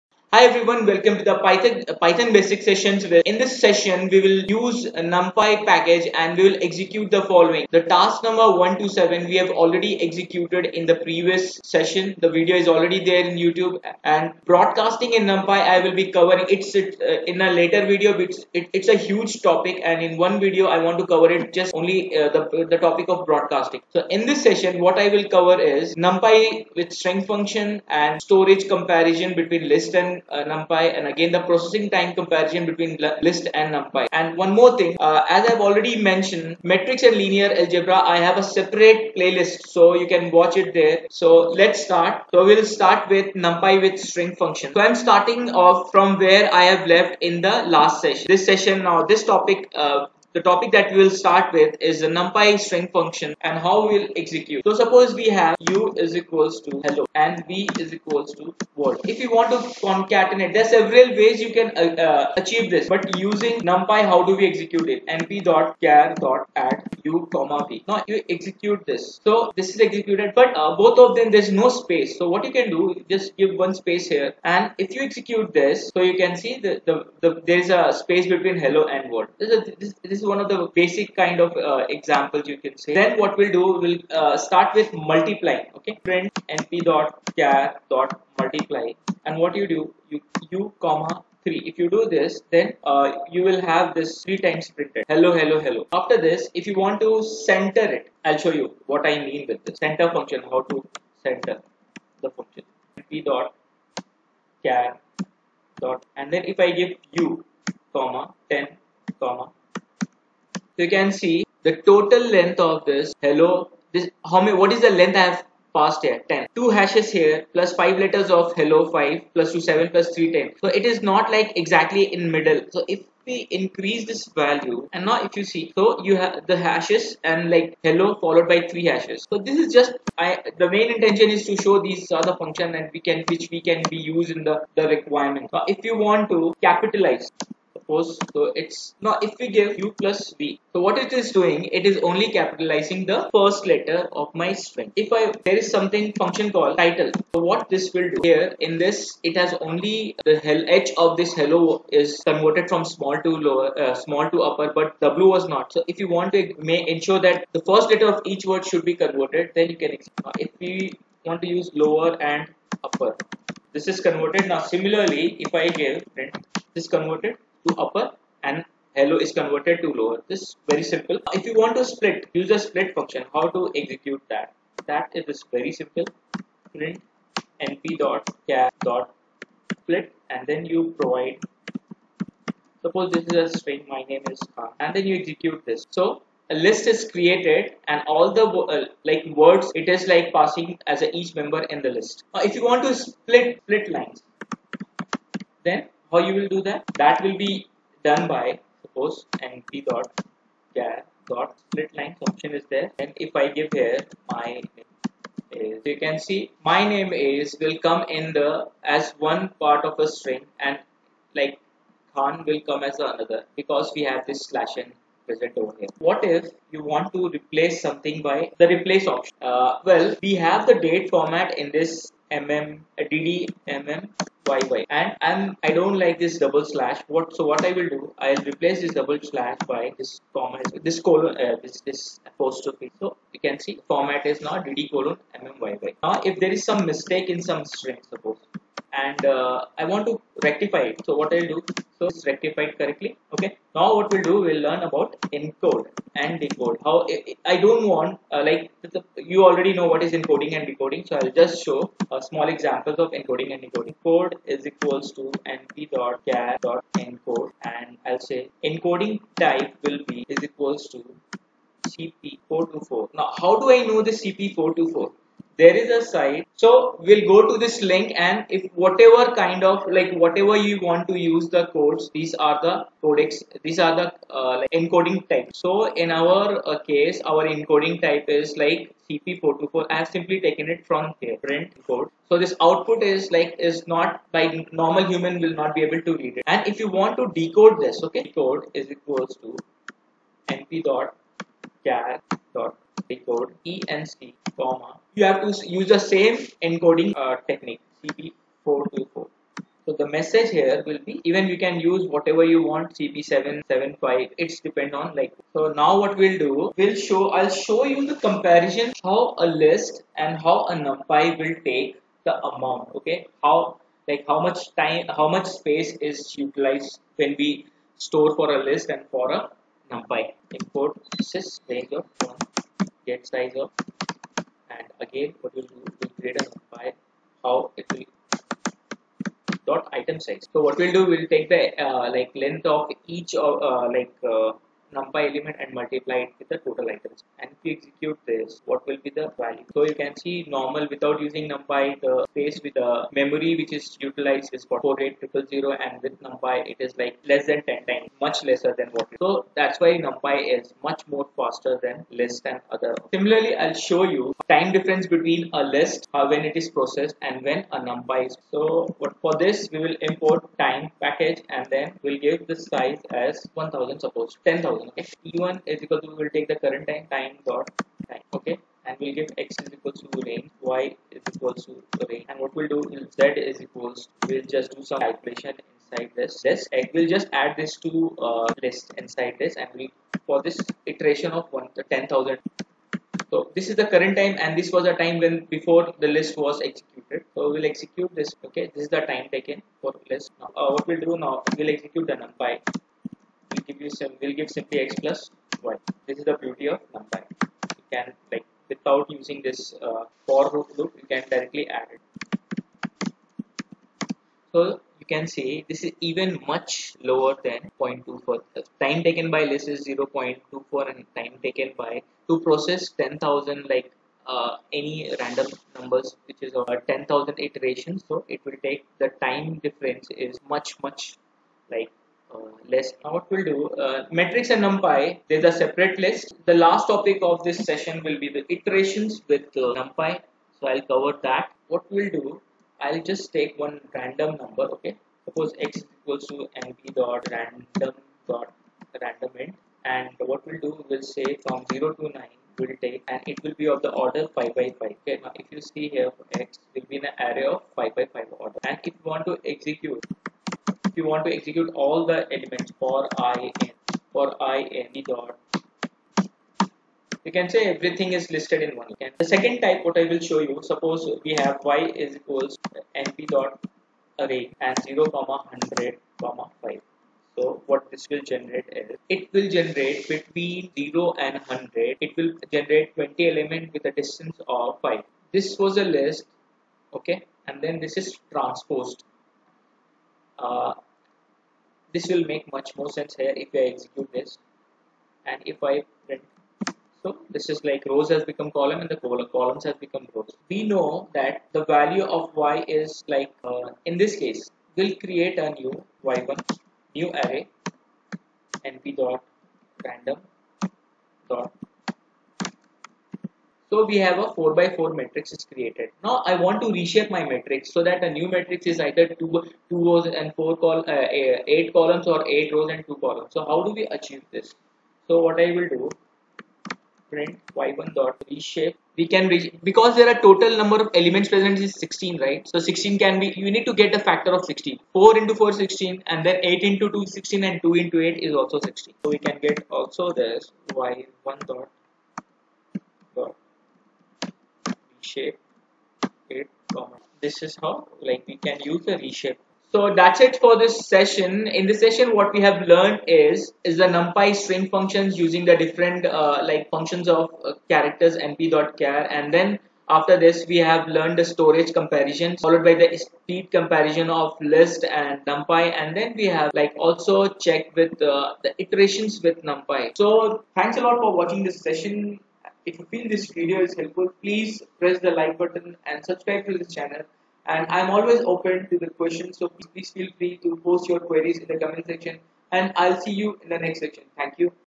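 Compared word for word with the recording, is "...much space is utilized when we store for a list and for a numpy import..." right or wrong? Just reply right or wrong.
right.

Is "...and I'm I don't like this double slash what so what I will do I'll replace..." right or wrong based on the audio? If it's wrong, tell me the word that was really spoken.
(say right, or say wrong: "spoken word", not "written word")
right.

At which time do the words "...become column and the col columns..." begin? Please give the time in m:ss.
8:08.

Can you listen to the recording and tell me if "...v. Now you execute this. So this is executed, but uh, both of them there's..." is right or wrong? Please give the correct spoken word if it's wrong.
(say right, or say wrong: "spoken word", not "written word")
right.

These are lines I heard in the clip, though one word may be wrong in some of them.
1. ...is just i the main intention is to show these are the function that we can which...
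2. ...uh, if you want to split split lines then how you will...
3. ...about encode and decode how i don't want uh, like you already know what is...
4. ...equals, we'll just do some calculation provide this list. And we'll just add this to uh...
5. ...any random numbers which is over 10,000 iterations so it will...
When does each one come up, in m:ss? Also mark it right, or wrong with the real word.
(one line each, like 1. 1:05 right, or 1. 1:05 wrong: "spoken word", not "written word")
1. 2:09 right
2. 3:12 right
3. 4:04 right
4. 6:13 wrong: "inside", not "provide"
5. 6:54 right.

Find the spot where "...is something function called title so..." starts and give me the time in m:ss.
2:25.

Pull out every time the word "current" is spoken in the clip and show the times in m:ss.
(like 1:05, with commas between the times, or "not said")
6:06, 6:23.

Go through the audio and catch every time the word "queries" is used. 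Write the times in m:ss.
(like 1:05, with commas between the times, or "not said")
9:30.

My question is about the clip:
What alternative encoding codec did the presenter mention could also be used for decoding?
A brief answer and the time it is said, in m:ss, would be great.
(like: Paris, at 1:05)
CP775, at 5:02.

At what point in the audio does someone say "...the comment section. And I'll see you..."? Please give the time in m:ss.
9:31.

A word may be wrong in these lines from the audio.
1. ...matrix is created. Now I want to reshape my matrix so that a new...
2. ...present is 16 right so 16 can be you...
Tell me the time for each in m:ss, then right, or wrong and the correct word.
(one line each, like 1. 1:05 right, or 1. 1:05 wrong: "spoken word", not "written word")
1. 8:24 right
2. 8:41 right.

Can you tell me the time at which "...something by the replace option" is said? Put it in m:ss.
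3:37.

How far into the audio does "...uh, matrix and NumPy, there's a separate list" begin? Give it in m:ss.
7:03.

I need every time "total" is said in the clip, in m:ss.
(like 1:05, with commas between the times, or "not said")
1:51, 5:36, 8:40.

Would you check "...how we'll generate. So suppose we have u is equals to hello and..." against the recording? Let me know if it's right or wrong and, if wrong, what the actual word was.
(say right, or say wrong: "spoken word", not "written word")
wrong: "execute", not "generate".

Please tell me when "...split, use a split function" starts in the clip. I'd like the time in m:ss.
2:51.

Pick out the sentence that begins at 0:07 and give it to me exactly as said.
The task number 1 to 7 we have already executed in the previous session.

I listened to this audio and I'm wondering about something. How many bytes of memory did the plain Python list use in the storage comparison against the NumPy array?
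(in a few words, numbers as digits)
48000.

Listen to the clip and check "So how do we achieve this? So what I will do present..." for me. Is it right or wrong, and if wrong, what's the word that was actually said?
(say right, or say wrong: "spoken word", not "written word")
wrong: "print", not "present".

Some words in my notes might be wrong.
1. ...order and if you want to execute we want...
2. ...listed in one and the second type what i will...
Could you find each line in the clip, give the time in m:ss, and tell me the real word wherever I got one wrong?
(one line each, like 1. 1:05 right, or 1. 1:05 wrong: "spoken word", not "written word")
1. 7:28 right
2. 7:38 right.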